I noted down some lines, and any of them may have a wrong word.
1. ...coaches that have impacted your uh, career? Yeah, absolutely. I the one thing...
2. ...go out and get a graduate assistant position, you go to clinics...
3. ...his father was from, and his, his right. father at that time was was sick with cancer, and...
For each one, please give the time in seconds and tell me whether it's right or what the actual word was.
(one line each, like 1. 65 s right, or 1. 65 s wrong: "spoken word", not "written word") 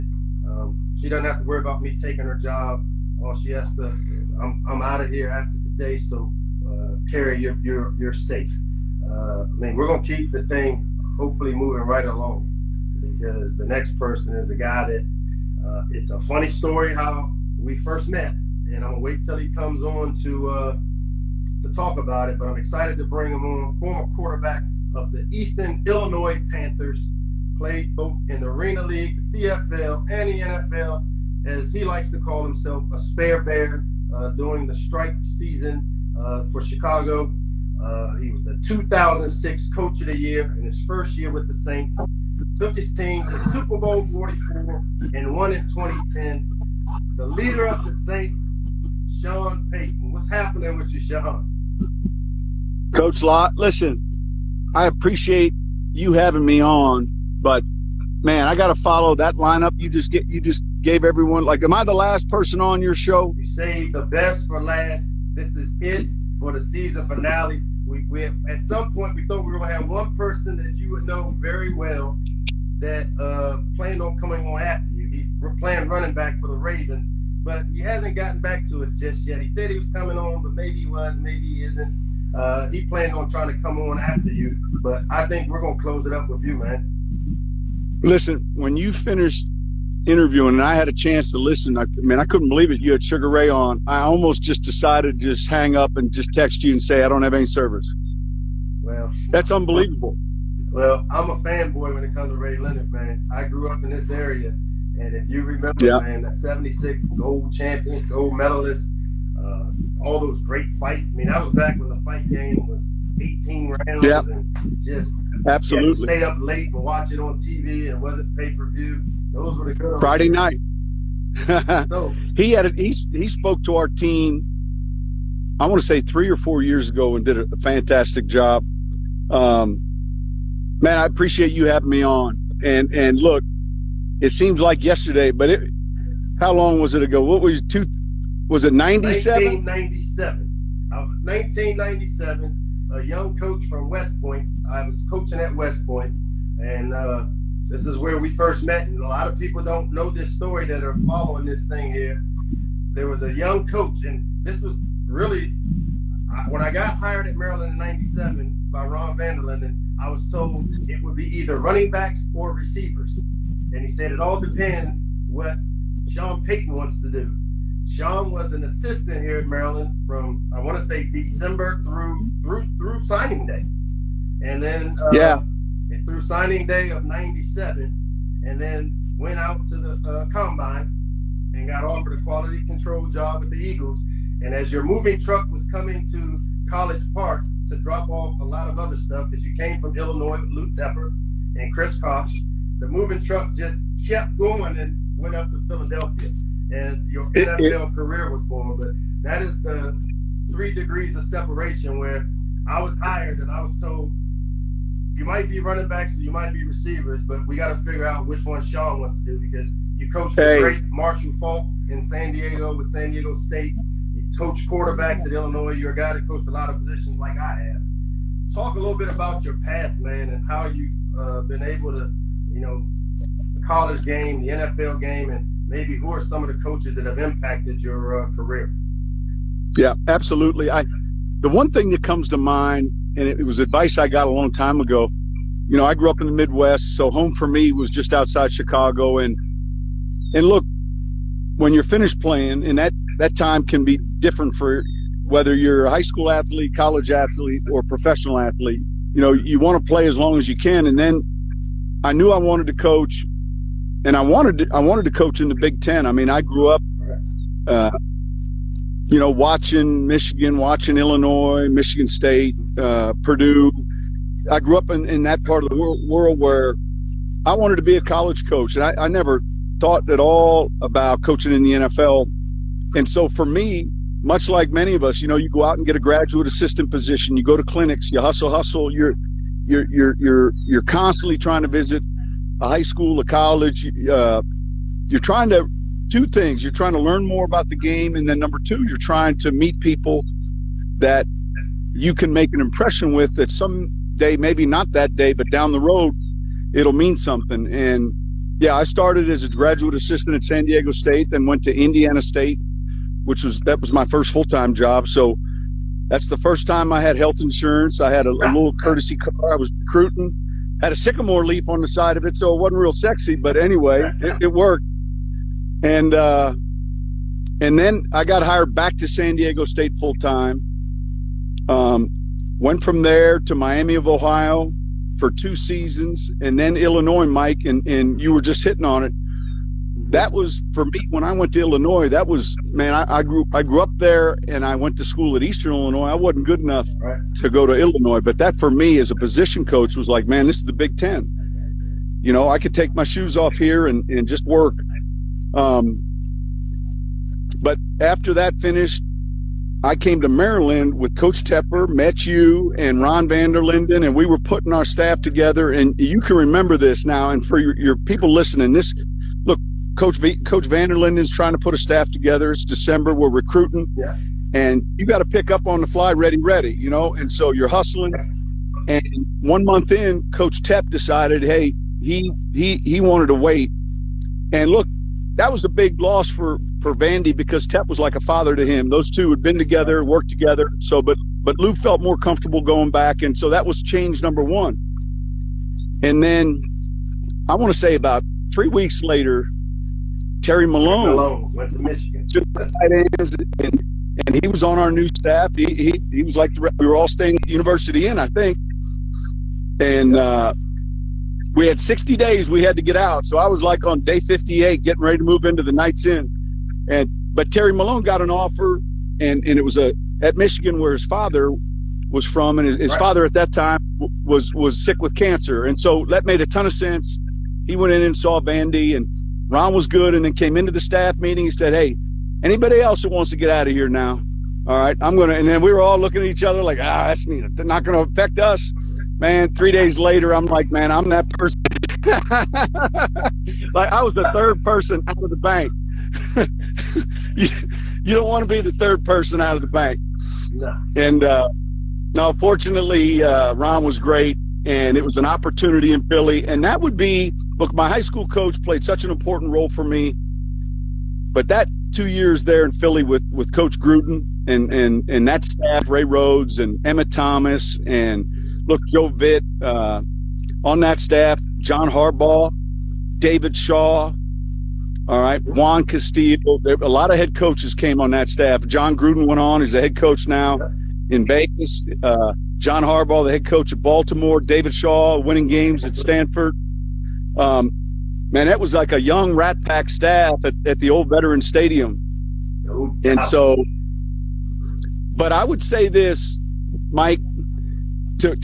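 1. 226 s right
2. 275 s right
3. 410 s right.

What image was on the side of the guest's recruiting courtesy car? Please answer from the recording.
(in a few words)
a sycamore leaf.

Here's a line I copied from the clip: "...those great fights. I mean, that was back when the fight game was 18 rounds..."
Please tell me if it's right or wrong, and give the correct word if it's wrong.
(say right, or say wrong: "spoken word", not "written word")
right.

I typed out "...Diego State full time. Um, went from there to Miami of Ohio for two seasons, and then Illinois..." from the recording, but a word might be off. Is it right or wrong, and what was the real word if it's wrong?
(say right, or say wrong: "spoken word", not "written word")
right.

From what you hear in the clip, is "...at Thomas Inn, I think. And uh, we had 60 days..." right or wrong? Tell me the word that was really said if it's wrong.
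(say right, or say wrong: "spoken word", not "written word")
wrong: "University", not "Thomas".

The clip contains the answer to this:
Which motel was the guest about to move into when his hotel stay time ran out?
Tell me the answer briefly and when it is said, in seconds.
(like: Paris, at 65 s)
Knights Inn, at 405 s.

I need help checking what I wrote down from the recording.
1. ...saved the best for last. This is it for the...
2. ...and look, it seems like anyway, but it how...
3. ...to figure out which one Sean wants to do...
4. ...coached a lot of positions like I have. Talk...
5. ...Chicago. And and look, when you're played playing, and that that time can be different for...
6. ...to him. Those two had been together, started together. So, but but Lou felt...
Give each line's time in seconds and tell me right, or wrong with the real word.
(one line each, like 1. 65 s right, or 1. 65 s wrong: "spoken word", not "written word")
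1. 63 s right
2. 132 s wrong: "yesterday", not "anyway"
3. 207 s right
4. 216 s right
5. 238 s wrong: "finished", not "played"
6. 378 s wrong: "worked", not "started".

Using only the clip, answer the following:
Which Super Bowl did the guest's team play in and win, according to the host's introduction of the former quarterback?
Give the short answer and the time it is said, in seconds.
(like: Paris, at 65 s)
Super Bowl 44, at 43 s.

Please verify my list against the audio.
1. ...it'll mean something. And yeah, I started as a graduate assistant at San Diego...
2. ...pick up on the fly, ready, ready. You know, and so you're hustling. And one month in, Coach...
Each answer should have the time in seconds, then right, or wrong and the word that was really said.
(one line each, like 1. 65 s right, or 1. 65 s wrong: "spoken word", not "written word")
1. 296 s right
2. 365 s right.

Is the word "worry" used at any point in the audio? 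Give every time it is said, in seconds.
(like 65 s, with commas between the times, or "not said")
1 s.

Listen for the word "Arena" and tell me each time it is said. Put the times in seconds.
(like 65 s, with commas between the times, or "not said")
28 s.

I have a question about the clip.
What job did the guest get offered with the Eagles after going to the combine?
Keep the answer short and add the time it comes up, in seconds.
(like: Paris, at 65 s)
quality control, at 182 s.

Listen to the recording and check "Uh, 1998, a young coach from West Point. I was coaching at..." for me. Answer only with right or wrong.
wrong.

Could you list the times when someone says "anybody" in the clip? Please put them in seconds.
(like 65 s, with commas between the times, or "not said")
422 s.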